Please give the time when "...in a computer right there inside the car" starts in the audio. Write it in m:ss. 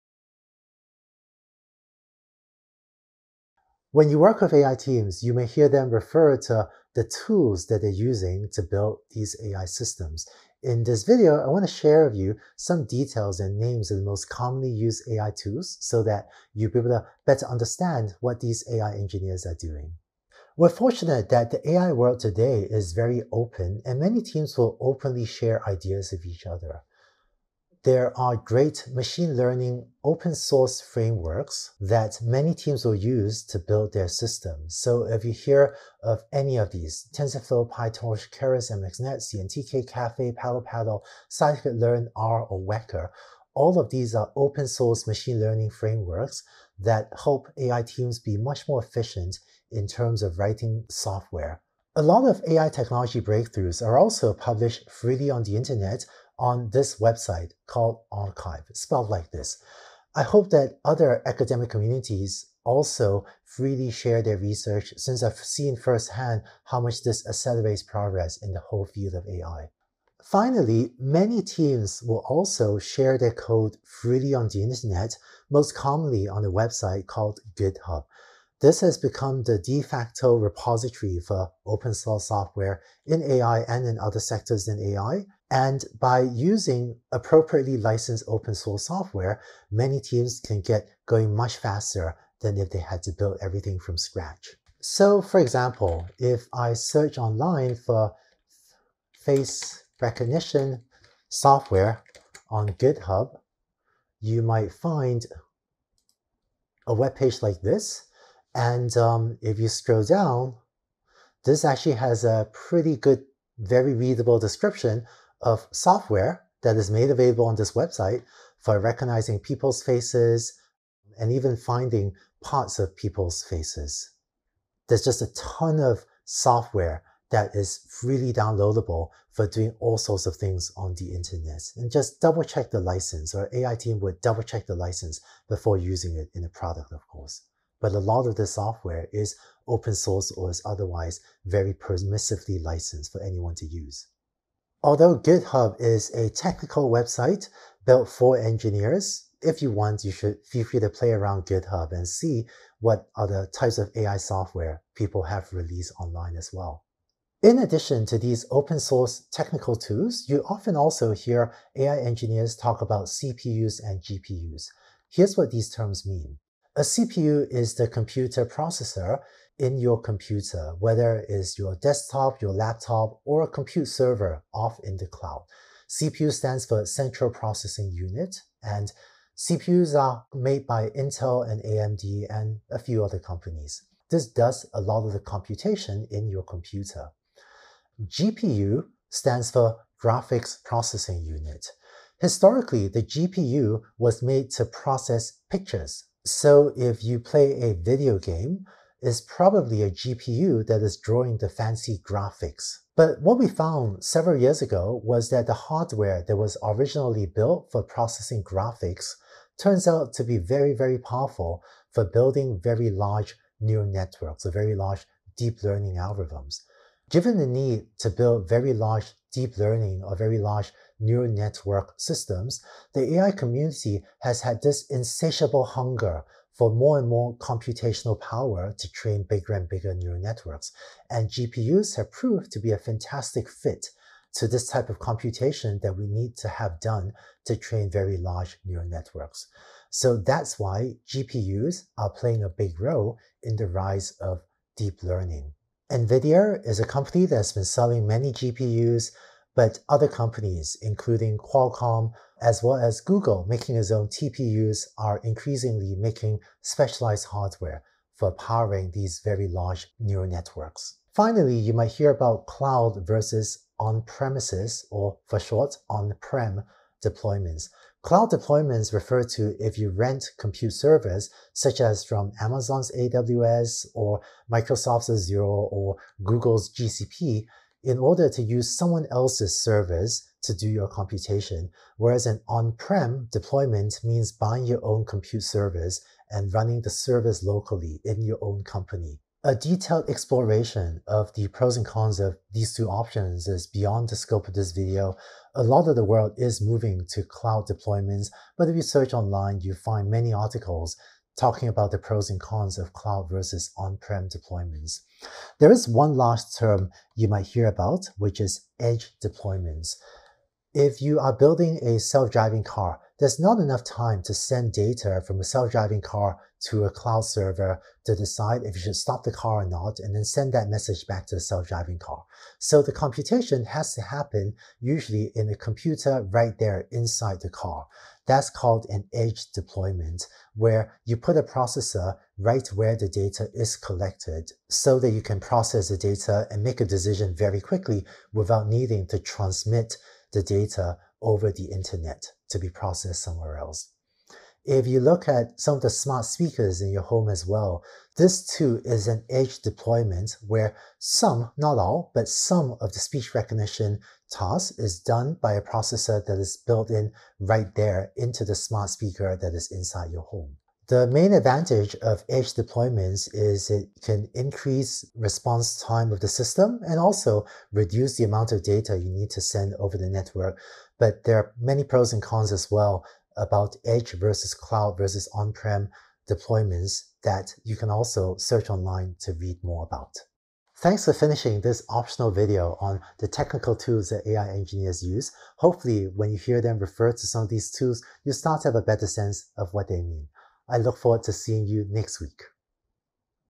5:25.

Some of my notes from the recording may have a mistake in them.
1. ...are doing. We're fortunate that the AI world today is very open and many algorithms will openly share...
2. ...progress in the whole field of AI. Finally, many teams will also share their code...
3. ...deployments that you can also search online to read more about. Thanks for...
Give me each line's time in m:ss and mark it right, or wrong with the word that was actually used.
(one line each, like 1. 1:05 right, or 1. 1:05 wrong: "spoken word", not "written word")
1. 0:19 wrong: "teams", not "algorithms"
2. 1:07 right
3. 6:16 right.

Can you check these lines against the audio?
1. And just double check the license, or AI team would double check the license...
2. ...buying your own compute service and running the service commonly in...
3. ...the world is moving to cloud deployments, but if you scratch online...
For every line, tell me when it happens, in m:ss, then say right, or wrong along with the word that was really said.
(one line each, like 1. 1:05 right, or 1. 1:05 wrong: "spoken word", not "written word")
1. 2:11 right
2. 4:44 wrong: "locally", not "commonly"
3. 4:55 wrong: "search", not "scratch".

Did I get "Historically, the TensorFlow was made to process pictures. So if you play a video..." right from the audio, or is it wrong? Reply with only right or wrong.
wrong.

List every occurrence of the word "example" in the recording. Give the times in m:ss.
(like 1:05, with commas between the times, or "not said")
1:35.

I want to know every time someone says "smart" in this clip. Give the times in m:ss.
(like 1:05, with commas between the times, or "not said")
5:45, 5:58.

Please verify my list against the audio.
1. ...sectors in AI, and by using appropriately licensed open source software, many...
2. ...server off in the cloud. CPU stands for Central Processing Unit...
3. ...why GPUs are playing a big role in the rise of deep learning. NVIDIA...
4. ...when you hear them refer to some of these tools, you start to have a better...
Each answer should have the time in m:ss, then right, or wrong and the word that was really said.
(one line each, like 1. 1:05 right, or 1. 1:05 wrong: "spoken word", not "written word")
1. 1:24 right
2. 2:53 right
3. 4:00 right
4. 6:26 right.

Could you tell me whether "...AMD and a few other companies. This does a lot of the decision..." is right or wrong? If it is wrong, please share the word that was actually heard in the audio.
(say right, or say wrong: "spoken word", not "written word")
wrong: "computation", not "decision".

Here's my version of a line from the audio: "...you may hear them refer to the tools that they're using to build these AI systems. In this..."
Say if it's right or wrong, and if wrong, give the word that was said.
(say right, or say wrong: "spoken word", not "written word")
right.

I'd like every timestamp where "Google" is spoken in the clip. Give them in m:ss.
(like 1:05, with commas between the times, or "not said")
4:13, 4:36.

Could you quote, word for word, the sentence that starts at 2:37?
In addition to these open source technical tools, you often also hear AI engineers talk about CPUs and GPUs.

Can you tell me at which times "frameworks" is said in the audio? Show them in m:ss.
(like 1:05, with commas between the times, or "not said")
0:30, 0:45.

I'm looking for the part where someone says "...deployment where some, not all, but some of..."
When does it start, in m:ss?
5:49.